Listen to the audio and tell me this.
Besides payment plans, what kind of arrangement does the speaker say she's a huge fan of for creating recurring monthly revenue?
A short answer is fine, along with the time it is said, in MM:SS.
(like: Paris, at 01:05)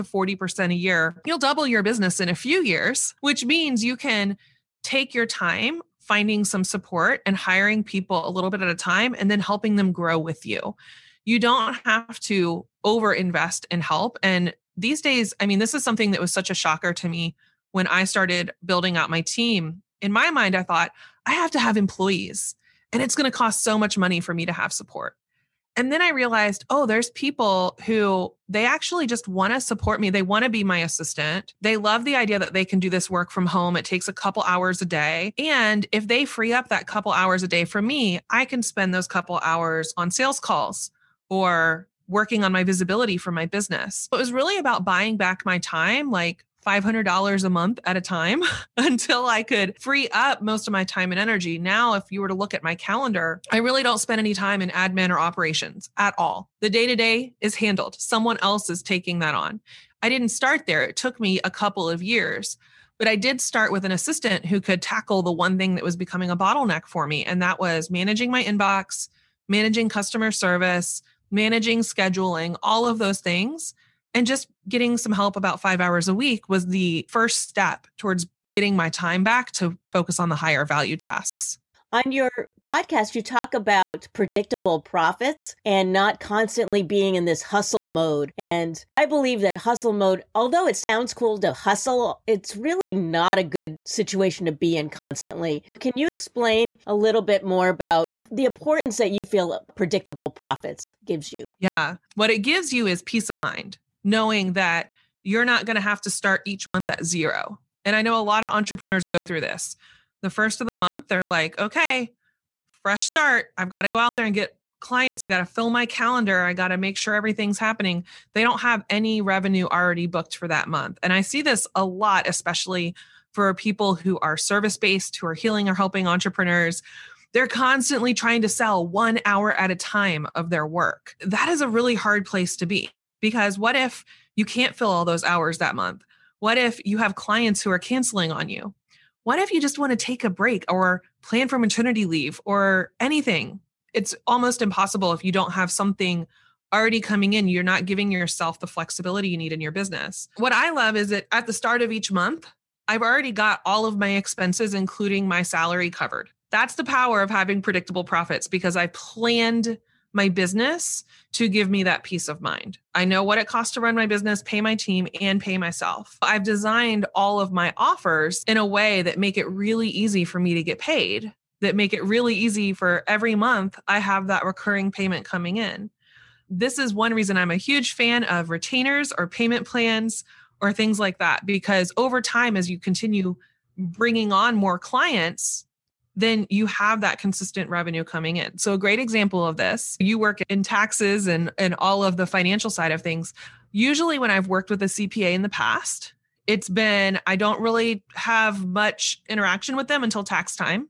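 Retainers, at 02:58.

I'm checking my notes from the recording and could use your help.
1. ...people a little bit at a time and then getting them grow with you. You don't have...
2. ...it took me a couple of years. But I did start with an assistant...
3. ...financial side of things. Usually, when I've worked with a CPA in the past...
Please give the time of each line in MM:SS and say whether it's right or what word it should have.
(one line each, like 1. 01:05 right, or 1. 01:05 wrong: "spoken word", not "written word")
1. 00:07 wrong: "helping", not "getting"
2. 01:00 right
3. 03:12 right.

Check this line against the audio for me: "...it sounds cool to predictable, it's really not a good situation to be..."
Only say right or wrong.
wrong.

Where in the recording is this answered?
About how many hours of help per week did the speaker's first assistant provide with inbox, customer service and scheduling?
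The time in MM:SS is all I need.
01:15.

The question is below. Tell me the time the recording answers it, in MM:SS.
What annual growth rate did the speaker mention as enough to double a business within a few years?
00:00.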